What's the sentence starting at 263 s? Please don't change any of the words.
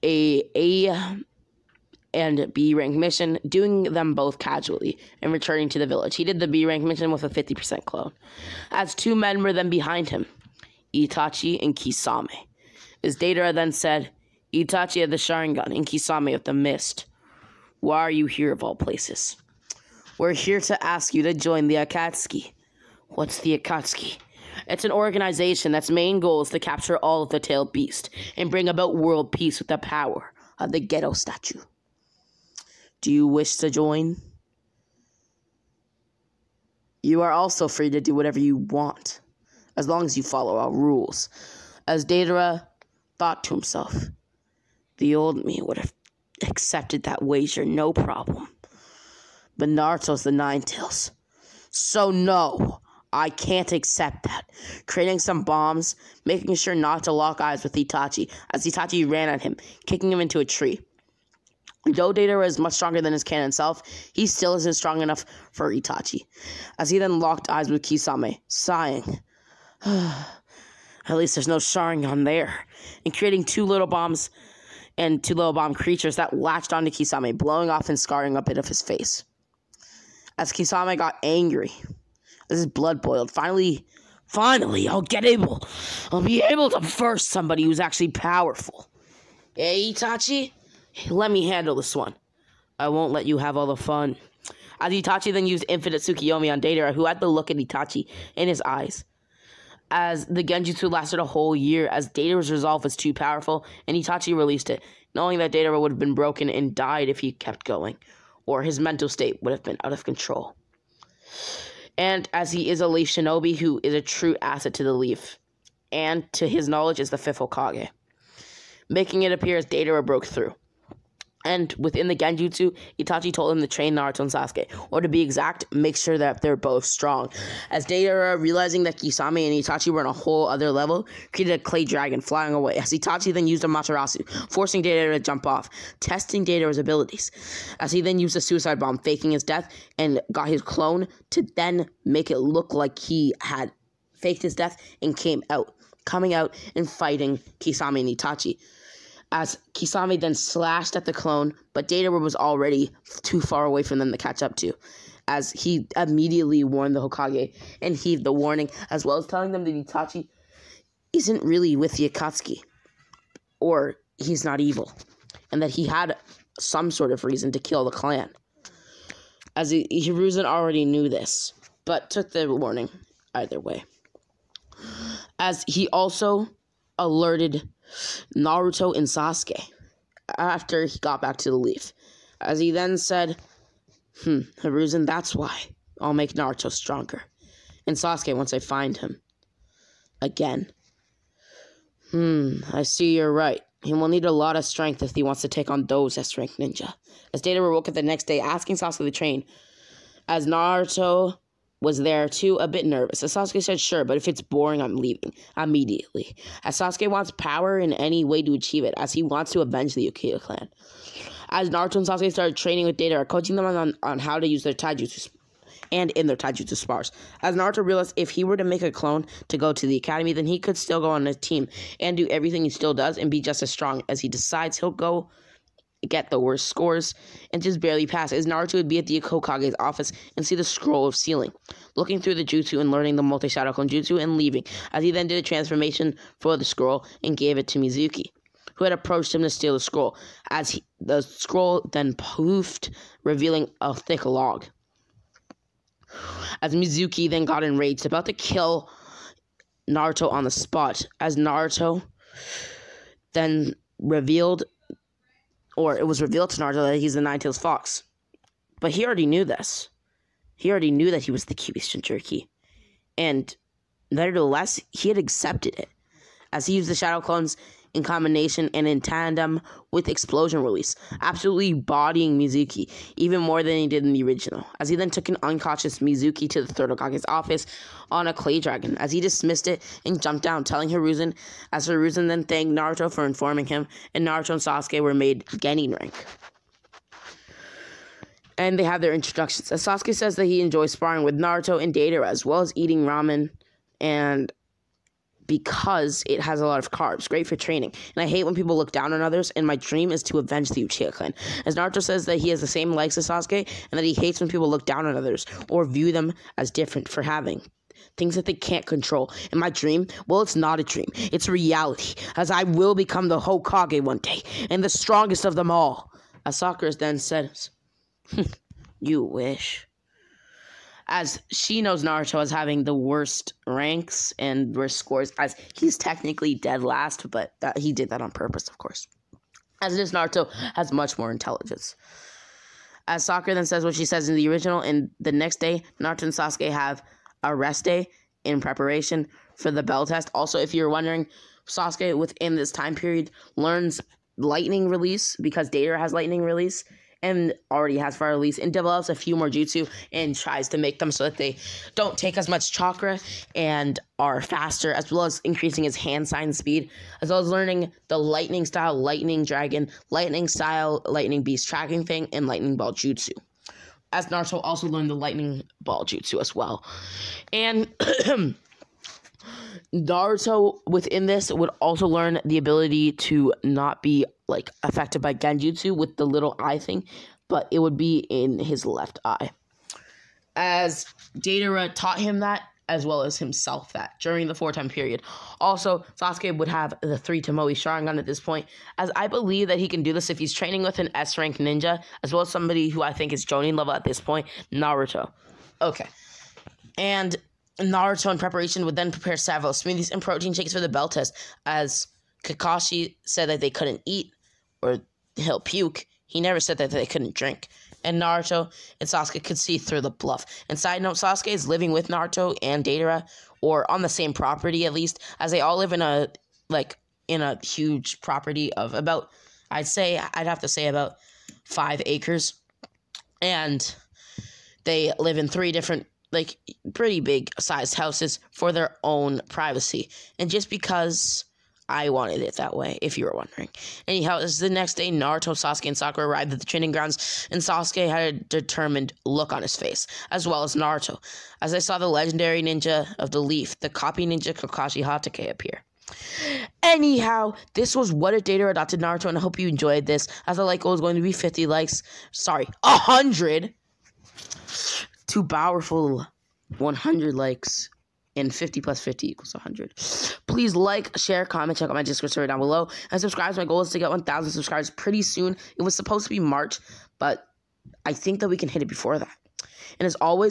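And nevertheless, he had accepted it.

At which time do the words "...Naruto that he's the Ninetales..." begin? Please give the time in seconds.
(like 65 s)
256 s.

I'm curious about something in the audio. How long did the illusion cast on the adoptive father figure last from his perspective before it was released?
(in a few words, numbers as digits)
a whole year.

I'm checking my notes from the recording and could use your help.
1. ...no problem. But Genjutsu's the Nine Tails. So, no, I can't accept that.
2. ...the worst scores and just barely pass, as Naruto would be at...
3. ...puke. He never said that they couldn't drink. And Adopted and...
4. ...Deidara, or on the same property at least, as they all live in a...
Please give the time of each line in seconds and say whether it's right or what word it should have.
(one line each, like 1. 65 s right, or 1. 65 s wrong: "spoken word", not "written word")
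1. 47 s wrong: "Naruto", not "Genjutsu"
2. 226 s right
3. 405 s wrong: "Naruto", not "Adopted"
4. 412 s right.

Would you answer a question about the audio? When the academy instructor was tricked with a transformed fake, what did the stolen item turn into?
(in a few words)
a thick log.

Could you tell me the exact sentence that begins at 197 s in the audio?
As Data woke up the next day asking Sasuke to train, as Naruto was there too, a bit nervous.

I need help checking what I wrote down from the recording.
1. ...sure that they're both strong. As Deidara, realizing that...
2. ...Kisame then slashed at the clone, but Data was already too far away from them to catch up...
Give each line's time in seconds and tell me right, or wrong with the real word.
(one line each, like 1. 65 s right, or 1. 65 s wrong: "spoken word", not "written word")
1. 125 s right
2. 149 s right.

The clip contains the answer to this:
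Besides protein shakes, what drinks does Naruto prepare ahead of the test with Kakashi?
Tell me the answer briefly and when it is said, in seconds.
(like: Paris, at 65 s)
smoothies, at 399 s.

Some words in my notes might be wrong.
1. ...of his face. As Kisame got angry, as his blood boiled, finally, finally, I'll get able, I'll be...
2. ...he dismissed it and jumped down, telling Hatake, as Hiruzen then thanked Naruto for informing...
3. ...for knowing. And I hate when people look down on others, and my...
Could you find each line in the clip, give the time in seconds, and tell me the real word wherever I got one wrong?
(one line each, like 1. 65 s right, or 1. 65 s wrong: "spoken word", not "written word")
1. 78 s right
2. 279 s wrong: "Hiruzen", not "Hatake"
3. 297 s wrong: "training", not "knowing".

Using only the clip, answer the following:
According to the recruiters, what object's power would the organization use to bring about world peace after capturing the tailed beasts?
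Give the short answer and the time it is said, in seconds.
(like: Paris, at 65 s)
Gedo statue, at 30 s.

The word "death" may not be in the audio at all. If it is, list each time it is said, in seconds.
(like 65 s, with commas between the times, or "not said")
139 s, 144 s.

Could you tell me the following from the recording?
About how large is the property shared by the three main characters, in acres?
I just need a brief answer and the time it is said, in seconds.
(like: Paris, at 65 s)
5, at 421 s.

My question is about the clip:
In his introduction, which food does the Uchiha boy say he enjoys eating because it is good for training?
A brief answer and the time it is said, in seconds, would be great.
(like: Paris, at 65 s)
ramen, at 293 s.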